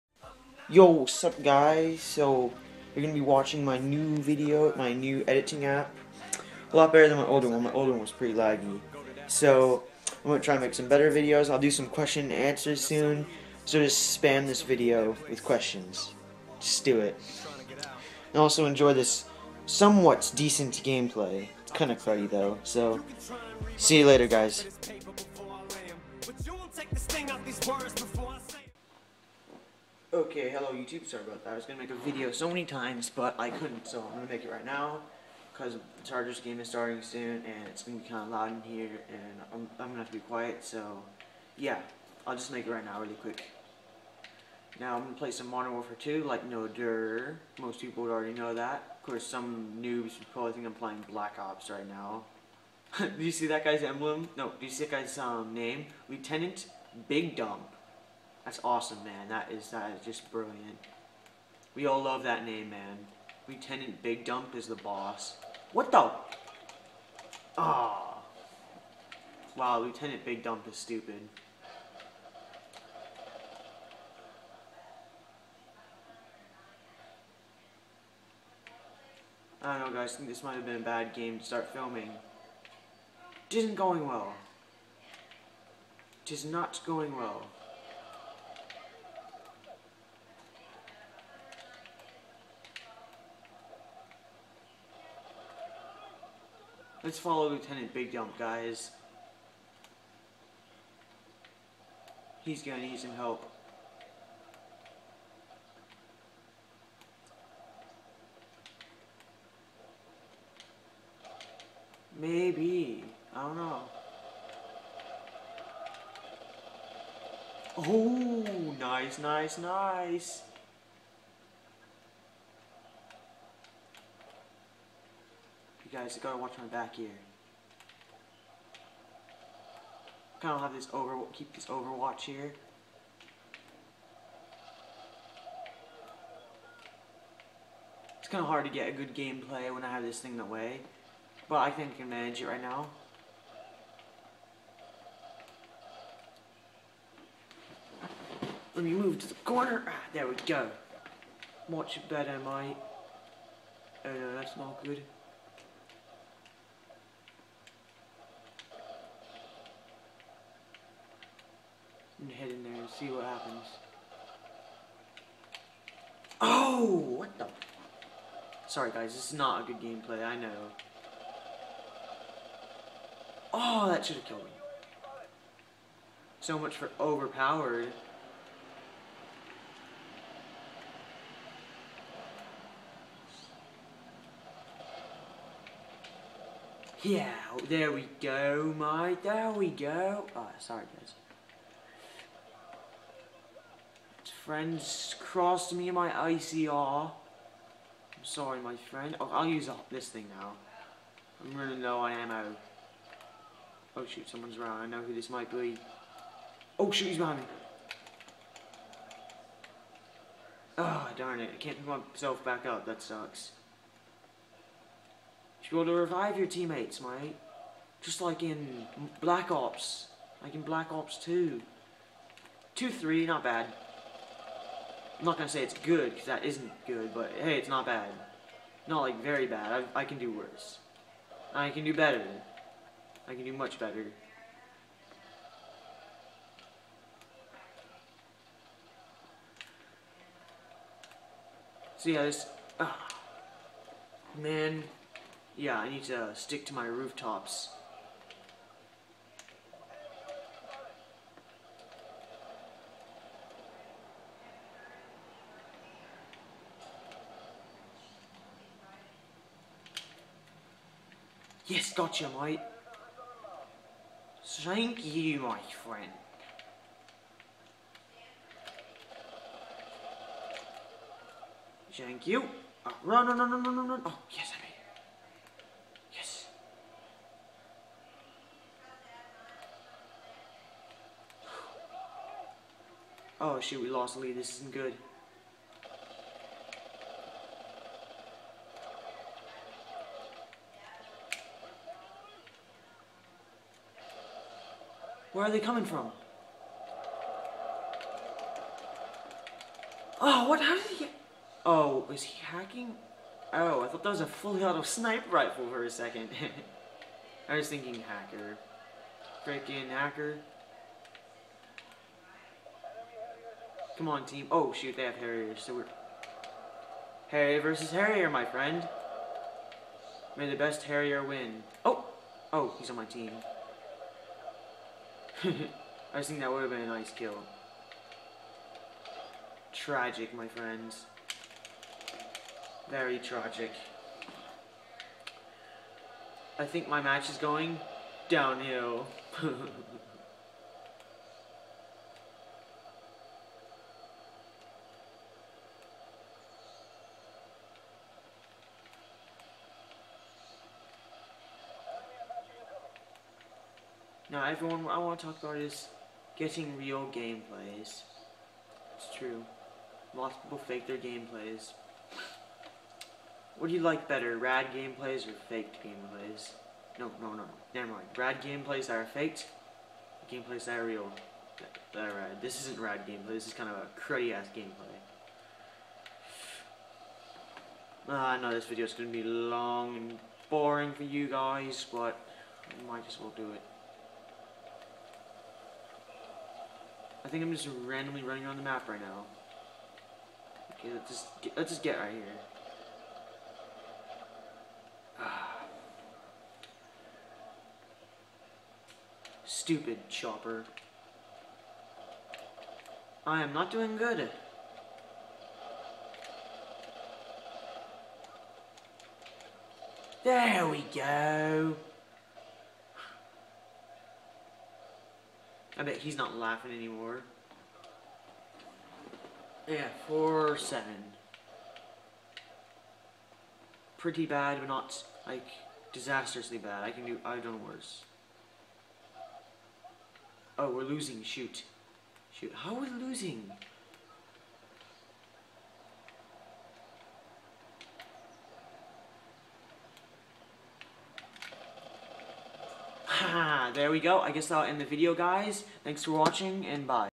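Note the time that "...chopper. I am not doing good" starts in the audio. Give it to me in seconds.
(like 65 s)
400 s.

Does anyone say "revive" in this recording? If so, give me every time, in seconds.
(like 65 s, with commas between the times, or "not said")
215 s.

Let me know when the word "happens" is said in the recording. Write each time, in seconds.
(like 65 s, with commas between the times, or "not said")
163 s.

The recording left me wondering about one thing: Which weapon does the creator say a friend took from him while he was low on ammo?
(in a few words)
ACR.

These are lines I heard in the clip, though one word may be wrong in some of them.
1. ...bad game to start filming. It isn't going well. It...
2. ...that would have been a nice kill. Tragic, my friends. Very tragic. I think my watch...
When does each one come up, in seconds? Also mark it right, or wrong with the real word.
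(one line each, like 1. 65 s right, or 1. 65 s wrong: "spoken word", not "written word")
1. 80 s right
2. 326 s wrong: "match", not "watch".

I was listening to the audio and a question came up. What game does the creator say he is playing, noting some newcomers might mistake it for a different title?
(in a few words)
Modern Warfare 2.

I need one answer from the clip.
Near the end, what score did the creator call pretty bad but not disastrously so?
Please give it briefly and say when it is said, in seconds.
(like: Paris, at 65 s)
4-7, at 420 s.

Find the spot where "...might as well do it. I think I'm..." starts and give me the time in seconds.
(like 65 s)
382 s.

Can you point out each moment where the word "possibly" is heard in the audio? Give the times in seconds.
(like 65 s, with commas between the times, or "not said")
not said.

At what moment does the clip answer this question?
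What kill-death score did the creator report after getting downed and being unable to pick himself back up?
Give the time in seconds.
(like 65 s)
222 s.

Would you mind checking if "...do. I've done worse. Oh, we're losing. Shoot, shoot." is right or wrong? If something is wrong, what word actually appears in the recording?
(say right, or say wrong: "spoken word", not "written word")
right.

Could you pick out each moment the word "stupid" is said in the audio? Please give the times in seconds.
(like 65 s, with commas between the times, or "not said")
70 s, 399 s.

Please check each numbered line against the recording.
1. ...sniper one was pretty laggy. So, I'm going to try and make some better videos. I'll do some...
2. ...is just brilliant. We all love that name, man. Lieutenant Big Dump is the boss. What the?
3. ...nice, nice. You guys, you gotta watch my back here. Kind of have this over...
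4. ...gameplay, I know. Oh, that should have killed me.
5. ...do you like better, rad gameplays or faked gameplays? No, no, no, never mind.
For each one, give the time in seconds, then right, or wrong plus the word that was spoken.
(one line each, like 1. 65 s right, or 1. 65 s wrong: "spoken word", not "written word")
1. 7 s wrong: "older", not "sniper"
2. 59 s right
3. 119 s right
4. 169 s right
5. 363 s right.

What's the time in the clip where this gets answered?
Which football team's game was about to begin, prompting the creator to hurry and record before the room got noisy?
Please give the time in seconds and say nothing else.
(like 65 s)
36 s.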